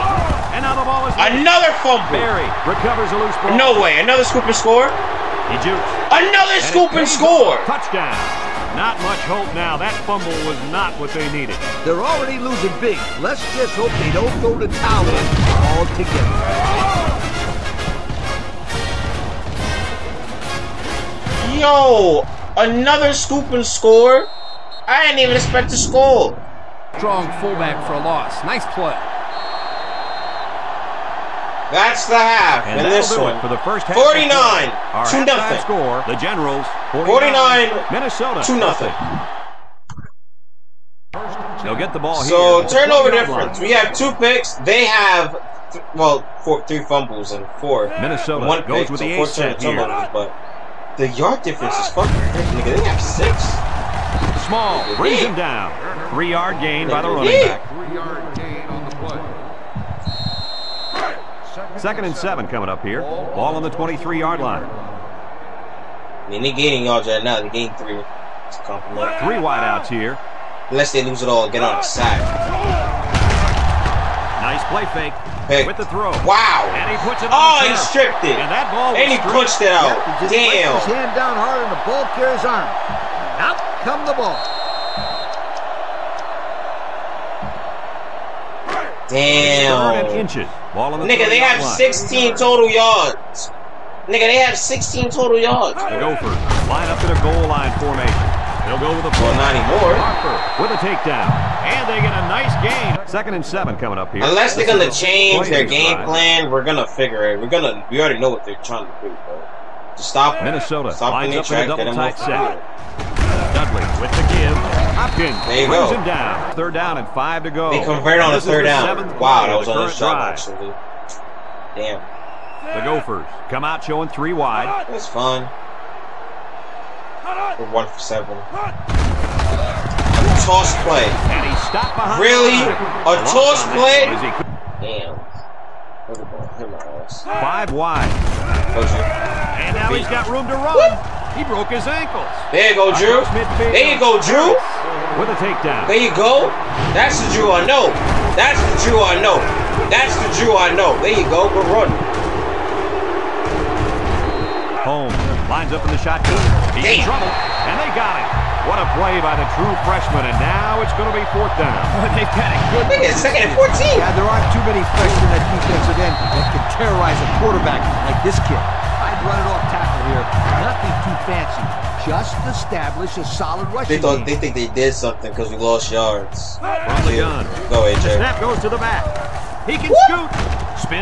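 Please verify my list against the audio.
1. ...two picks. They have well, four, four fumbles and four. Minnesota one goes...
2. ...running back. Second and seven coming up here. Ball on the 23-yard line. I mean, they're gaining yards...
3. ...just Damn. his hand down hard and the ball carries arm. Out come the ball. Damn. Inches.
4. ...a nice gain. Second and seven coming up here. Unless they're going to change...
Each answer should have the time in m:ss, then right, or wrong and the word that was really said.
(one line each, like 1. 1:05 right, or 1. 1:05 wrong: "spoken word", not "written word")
1. 0:43 wrong: "three", not "four"
2. 0:57 right
3. 1:20 right
4. 1:42 right.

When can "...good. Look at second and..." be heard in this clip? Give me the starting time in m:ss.
2:42.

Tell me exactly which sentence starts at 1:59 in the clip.
Wow, that was on a shot, actually.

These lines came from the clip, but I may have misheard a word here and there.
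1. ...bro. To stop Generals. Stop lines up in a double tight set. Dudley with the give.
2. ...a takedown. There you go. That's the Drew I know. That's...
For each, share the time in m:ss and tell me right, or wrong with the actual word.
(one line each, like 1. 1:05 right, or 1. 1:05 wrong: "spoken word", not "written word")
1. 1:49 wrong: "Minnesota", not "Generals"
2. 2:25 right.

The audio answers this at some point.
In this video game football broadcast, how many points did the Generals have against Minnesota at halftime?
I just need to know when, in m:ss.
0:33.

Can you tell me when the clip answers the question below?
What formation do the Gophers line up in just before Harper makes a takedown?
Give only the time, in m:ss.
1:37.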